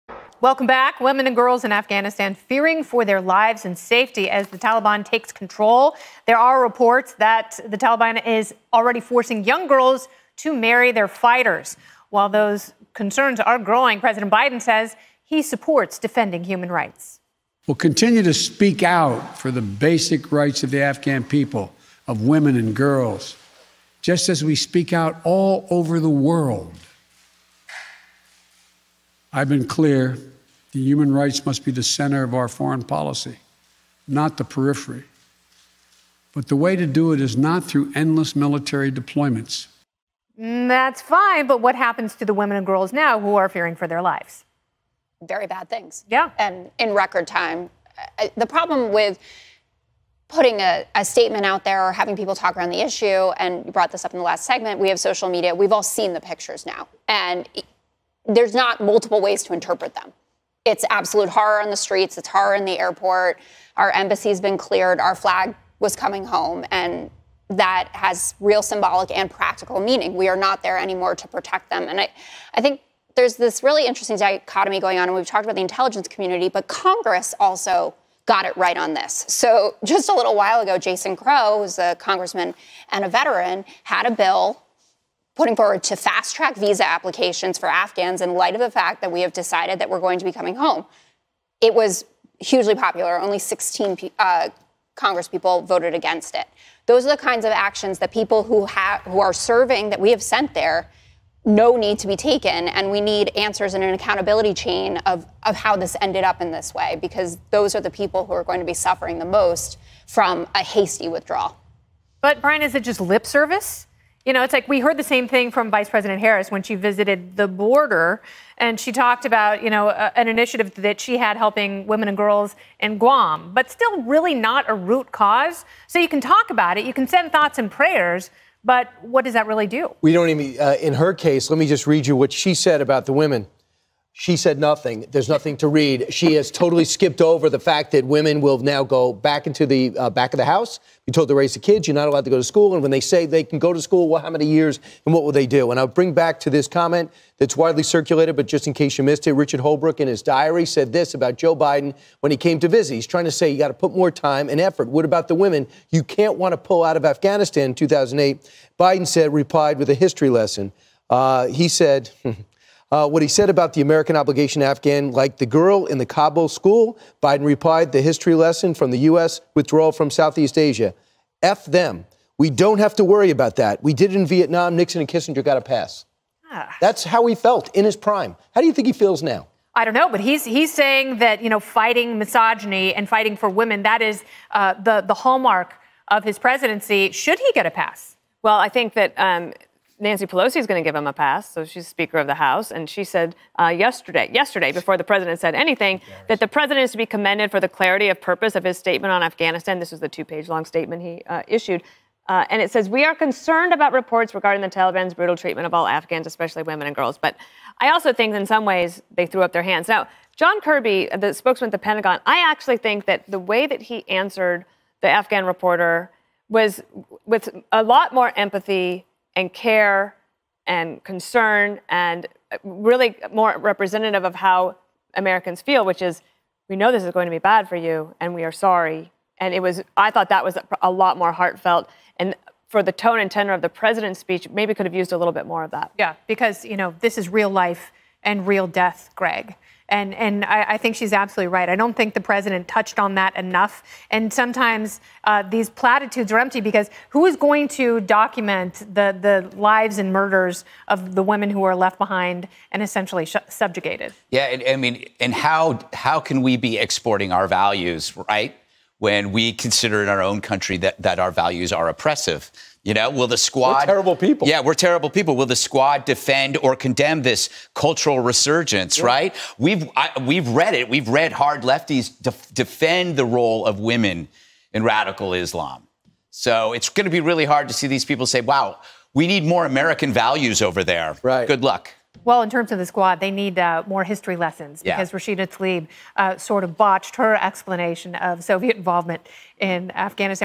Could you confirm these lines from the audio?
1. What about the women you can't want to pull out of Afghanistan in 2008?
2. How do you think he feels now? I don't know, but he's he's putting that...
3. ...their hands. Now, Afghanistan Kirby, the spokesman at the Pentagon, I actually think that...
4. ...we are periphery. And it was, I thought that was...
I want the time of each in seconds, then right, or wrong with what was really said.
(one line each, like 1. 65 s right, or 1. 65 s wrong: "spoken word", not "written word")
1. 154 s right
2. 178 s wrong: "saying", not "putting"
3. 209 s wrong: "John", not "Afghanistan"
4. 228 s wrong: "sorry", not "periphery".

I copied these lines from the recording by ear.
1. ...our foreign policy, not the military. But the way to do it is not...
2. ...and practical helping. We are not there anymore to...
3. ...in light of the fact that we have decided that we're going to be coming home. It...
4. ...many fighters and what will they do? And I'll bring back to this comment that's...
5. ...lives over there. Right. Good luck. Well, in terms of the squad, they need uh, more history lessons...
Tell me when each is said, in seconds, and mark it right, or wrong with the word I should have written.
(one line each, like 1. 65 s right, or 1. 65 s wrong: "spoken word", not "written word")
1. 32 s wrong: "periphery", not "military"
2. 69 s wrong: "meaning", not "helping"
3. 88 s right
4. 144 s wrong: "years", not "fighters"
5. 280 s wrong: "values", not "lives".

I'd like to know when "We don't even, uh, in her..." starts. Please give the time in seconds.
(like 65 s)
130 s.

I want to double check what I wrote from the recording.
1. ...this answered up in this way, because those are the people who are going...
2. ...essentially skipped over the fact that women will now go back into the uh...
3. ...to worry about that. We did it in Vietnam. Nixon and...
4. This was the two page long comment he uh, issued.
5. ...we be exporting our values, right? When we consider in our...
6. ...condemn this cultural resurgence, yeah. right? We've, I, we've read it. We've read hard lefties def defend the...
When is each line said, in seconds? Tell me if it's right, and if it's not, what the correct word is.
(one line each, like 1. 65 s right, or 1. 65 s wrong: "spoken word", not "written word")
1. 105 s wrong: "ended", not "answered"
2. 136 s wrong: "totally", not "essentially"
3. 172 s right
4. 199 s wrong: "statement", not "comment"
5. 256 s right
6. 266 s right.